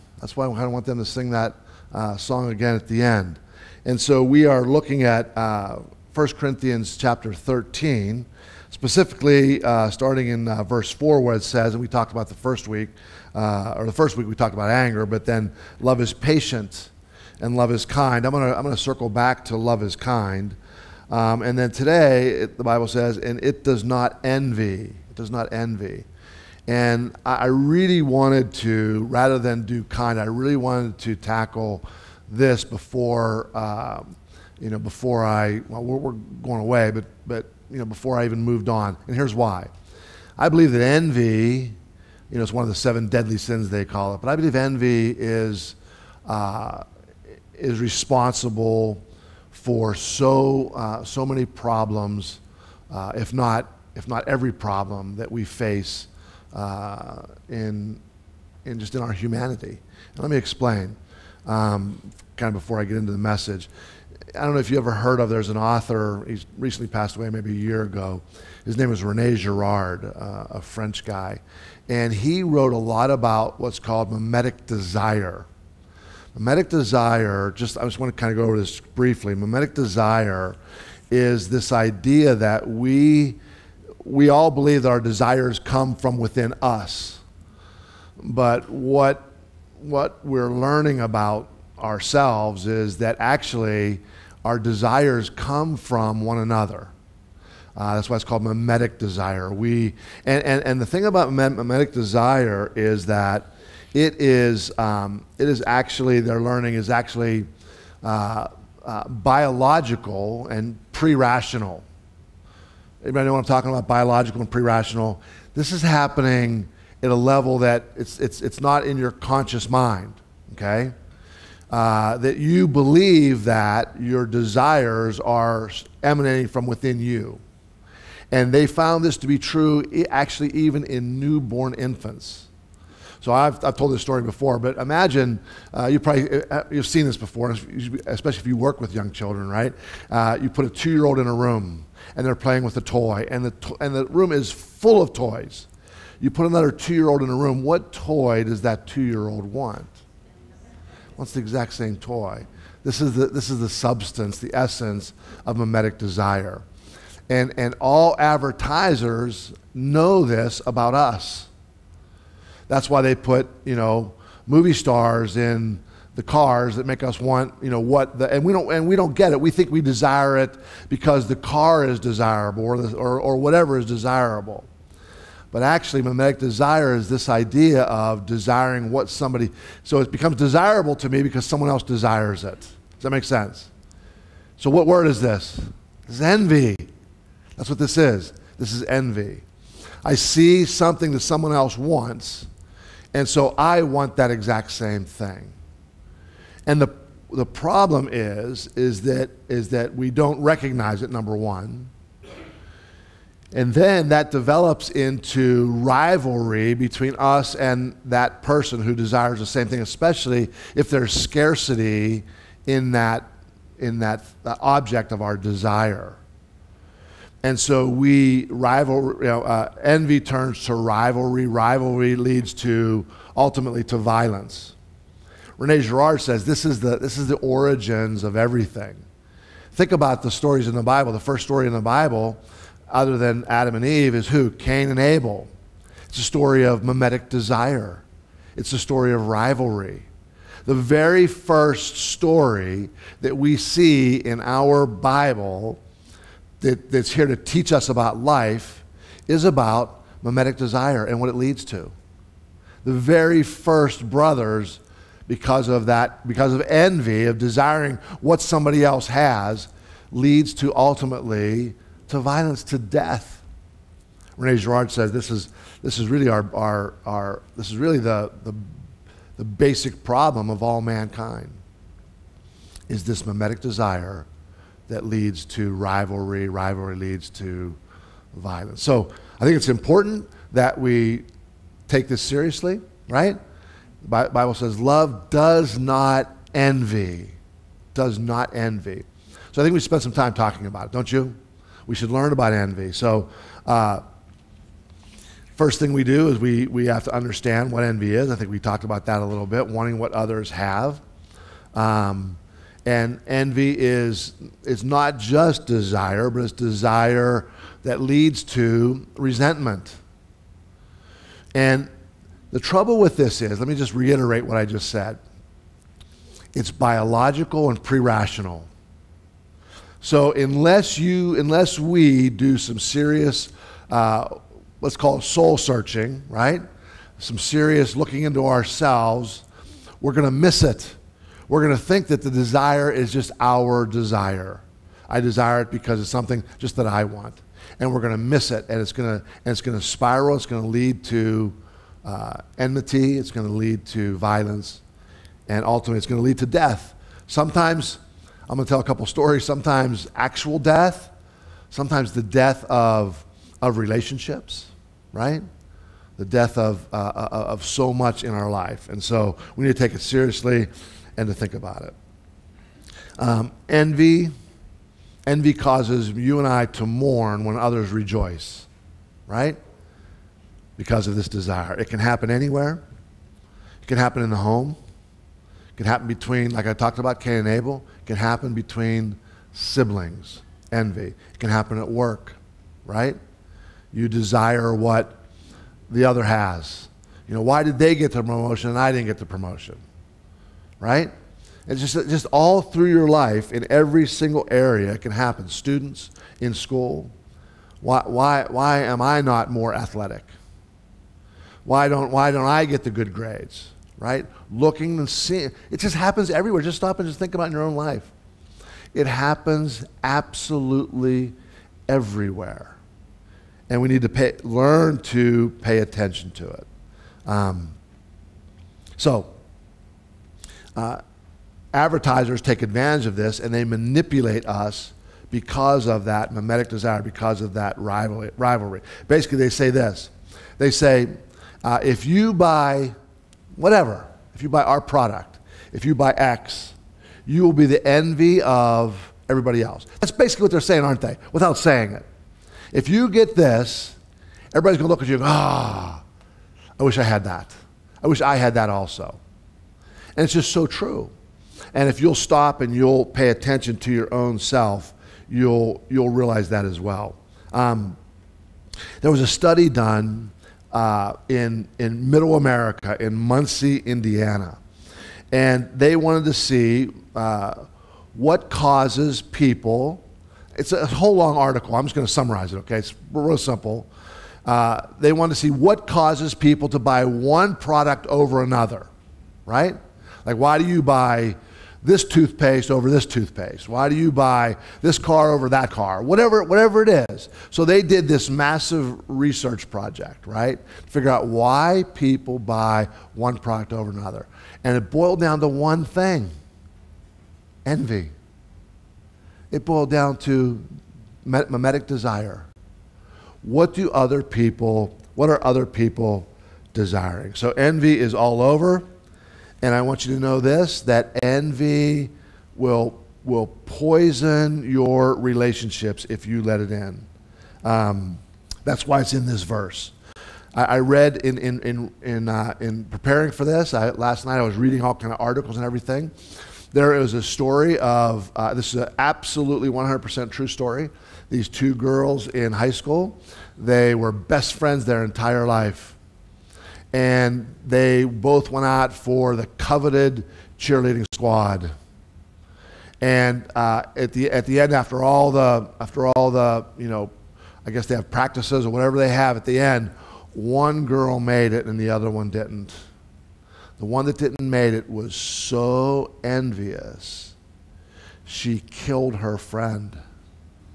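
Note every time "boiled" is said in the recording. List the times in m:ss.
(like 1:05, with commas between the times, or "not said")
8:14, 8:19.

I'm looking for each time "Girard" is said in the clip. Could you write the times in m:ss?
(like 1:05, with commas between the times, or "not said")
1:09, 3:45, 4:24.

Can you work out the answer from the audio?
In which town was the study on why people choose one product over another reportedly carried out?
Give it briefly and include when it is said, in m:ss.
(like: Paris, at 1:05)
Muncie, Indiana, at 7:43.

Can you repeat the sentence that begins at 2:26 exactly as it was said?
You put another two-year-old in a room.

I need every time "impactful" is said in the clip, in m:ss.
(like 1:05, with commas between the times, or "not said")
not said.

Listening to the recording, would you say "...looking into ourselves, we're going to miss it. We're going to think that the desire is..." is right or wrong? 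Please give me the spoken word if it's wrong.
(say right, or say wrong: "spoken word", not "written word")
right.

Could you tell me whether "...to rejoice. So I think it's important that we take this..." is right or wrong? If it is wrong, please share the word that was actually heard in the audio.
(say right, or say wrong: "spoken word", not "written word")
wrong: "violence", not "rejoice".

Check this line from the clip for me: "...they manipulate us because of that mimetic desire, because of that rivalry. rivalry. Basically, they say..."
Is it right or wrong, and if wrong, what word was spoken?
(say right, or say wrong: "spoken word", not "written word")
right.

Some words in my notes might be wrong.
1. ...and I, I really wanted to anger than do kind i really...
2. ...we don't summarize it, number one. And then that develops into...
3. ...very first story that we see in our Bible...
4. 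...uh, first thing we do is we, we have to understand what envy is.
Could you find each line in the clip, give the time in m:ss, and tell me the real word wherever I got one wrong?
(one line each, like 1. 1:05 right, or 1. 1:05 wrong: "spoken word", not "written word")
1. 0:26 wrong: "rather", not "anger"
2. 3:19 wrong: "recognize", not "summarize"
3. 4:00 right
4. 4:53 right.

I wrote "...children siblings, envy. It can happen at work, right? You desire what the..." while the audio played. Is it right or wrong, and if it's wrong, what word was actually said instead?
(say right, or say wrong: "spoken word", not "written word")
wrong: "between", not "children".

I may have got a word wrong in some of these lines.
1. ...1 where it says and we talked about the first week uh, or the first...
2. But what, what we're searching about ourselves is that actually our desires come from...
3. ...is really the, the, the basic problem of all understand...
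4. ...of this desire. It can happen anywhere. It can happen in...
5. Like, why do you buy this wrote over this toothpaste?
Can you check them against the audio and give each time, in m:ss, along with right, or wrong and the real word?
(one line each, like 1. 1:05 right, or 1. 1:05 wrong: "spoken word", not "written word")
1. 0:10 wrong: "4", not "1"
2. 1:28 wrong: "learning", not "searching"
3. 4:27 wrong: "mankind", not "understand"
4. 6:11 right
5. 8:00 wrong: "toothpaste", not "wrote".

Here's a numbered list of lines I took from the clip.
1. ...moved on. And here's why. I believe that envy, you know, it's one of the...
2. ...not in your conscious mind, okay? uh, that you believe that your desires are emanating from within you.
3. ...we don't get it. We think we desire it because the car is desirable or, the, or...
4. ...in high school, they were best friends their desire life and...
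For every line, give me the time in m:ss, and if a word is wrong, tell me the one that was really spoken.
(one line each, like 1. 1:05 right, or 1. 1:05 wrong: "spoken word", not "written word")
1. 0:38 right
2. 1:58 right
3. 2:48 right
4. 8:52 wrong: "entire", not "desire".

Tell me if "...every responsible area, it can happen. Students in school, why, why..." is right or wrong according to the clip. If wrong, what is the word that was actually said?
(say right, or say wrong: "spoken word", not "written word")
wrong: "single", not "responsible".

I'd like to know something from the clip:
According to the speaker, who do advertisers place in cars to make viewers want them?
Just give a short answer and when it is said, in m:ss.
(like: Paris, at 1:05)
Movie stars, at 2:44.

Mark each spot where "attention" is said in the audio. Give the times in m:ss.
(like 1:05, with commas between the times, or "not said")
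6:55, 7:33.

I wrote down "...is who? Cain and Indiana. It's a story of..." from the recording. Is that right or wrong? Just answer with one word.
wrong.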